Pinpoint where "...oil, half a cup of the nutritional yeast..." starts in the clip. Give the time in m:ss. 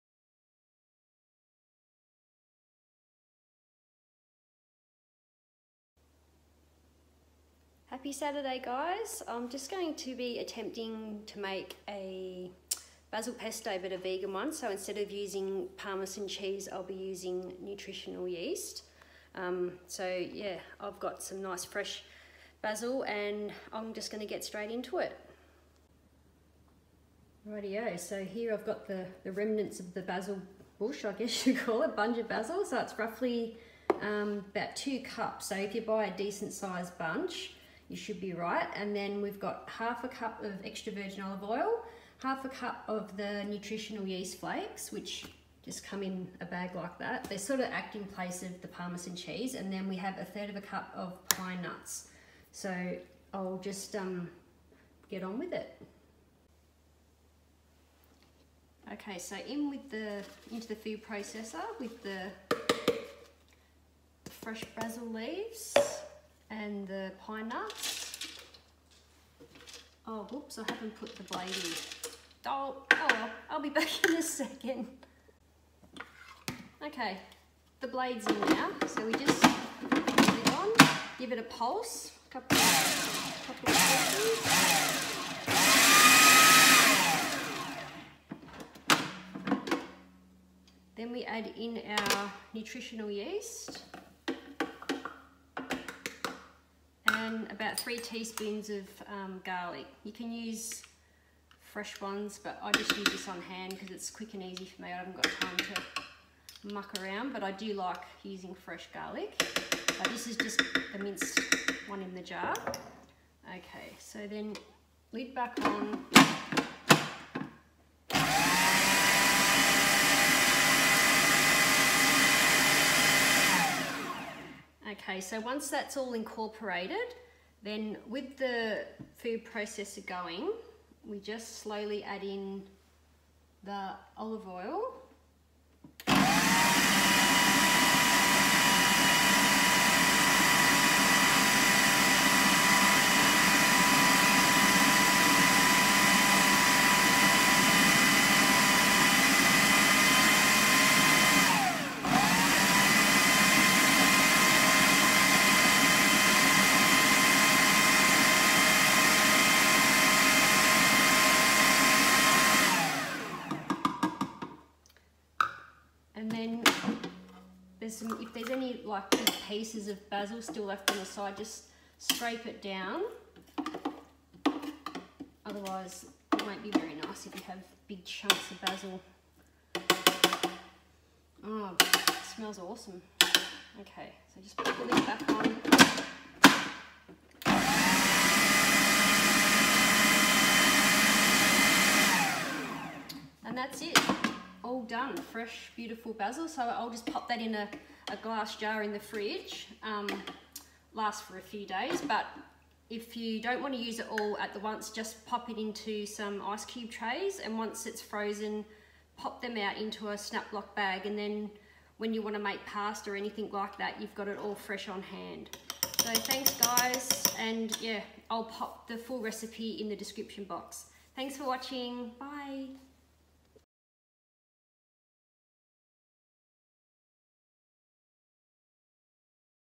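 0:41.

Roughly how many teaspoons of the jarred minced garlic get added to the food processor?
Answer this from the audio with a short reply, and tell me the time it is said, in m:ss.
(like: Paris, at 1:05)
3, at 1:37.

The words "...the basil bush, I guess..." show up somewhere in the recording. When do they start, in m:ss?
0:29.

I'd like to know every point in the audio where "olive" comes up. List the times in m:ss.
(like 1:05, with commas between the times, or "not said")
0:41, 2:14.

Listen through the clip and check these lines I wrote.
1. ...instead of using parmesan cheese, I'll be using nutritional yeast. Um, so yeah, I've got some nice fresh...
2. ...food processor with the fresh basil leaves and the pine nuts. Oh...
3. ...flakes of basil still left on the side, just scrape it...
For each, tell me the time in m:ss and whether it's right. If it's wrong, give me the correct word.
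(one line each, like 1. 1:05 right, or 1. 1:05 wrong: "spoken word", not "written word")
1. 0:14 right
2. 1:00 right
3. 2:49 wrong: "pieces", not "flakes".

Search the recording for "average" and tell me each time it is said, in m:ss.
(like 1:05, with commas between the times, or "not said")
not said.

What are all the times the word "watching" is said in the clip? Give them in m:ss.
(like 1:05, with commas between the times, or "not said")
3:41.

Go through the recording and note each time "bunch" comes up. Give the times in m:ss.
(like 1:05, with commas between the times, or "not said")
0:31, 0:36.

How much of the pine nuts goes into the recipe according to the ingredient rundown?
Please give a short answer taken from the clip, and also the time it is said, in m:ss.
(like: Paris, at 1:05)
1/3 cup, at 0:50.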